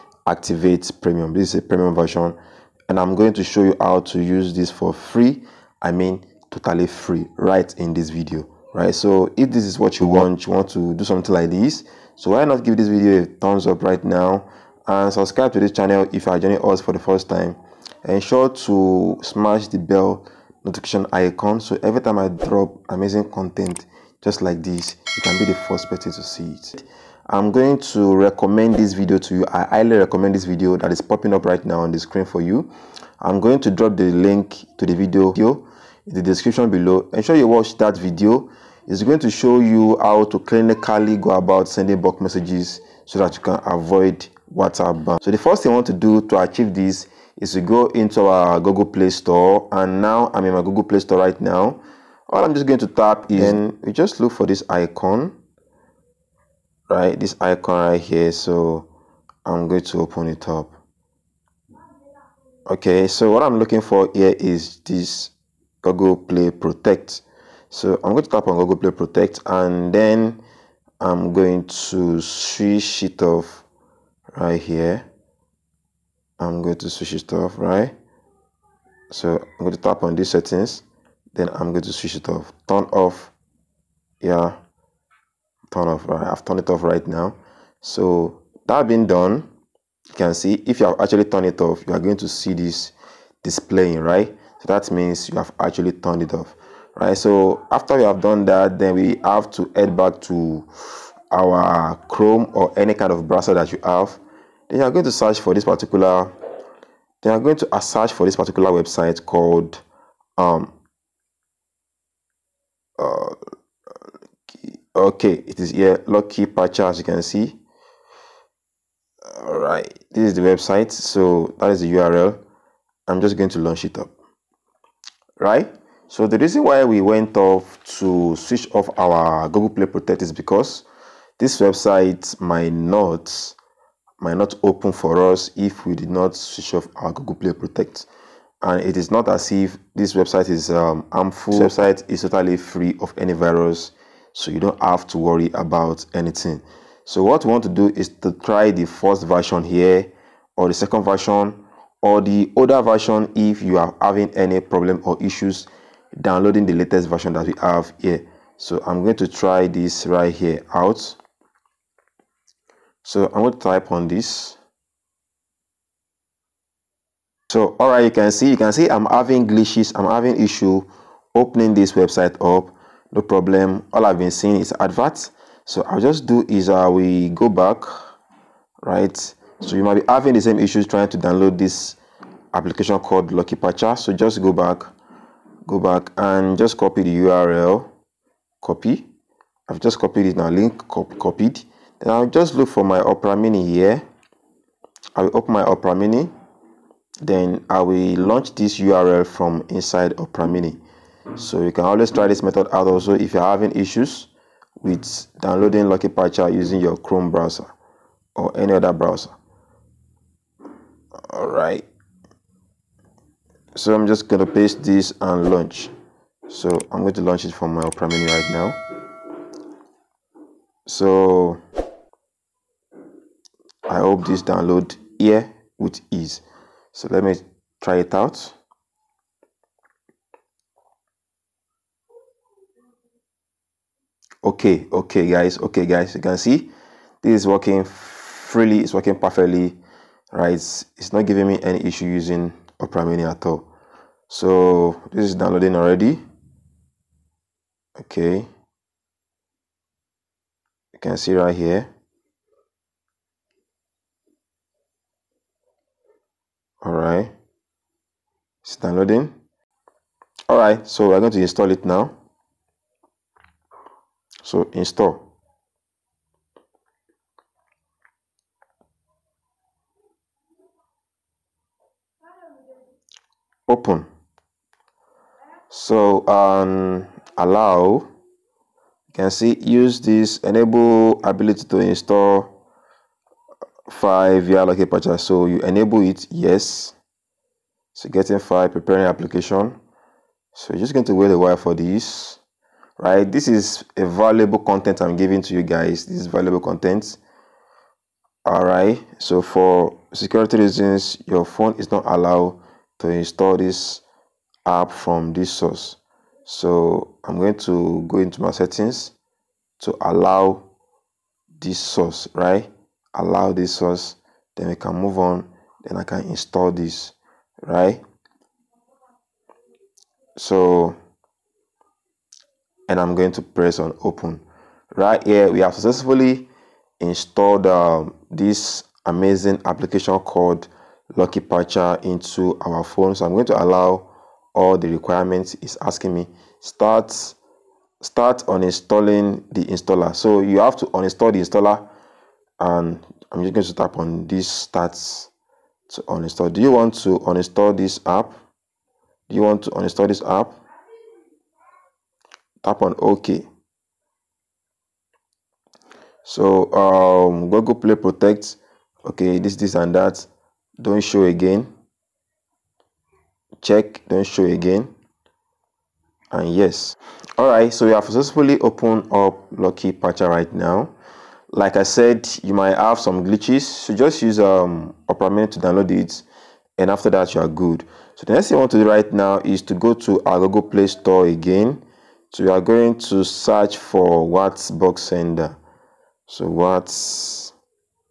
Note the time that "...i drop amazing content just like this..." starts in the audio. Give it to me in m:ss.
0:22.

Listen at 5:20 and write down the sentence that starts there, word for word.
So, and I'm going to press on open.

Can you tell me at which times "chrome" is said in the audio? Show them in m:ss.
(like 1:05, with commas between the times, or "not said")
1:42, 3:26.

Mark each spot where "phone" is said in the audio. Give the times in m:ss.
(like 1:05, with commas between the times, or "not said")
5:01, 5:32.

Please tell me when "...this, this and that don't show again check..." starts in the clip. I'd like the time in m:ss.
5:59.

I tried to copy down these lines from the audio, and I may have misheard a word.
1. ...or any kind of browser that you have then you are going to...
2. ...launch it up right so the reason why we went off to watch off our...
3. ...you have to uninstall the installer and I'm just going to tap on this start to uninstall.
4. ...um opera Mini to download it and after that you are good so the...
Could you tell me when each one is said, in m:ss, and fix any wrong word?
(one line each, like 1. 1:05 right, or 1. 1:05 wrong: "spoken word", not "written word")
1. 1:42 right
2. 2:03 wrong: "switch", not "watch"
3. 5:40 right
4. 6:14 right.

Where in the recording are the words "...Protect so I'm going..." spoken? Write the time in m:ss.
1:06.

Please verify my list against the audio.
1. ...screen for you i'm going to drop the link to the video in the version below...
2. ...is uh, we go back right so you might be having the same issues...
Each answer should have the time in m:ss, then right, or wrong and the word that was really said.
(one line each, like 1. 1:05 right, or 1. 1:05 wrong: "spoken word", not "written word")
1. 0:31 wrong: "description", not "version"
2. 2:56 right.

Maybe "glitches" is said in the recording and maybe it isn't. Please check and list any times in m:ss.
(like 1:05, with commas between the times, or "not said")
2:49, 6:13.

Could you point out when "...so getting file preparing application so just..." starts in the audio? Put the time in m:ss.
4:47.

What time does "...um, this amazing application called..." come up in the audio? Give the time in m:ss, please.
5:27.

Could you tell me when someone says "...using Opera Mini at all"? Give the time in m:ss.
4:02.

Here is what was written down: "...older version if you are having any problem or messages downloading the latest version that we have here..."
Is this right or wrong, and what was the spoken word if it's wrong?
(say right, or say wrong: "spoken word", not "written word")
wrong: "issues", not "messages".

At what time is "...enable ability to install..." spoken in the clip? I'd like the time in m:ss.
4:40.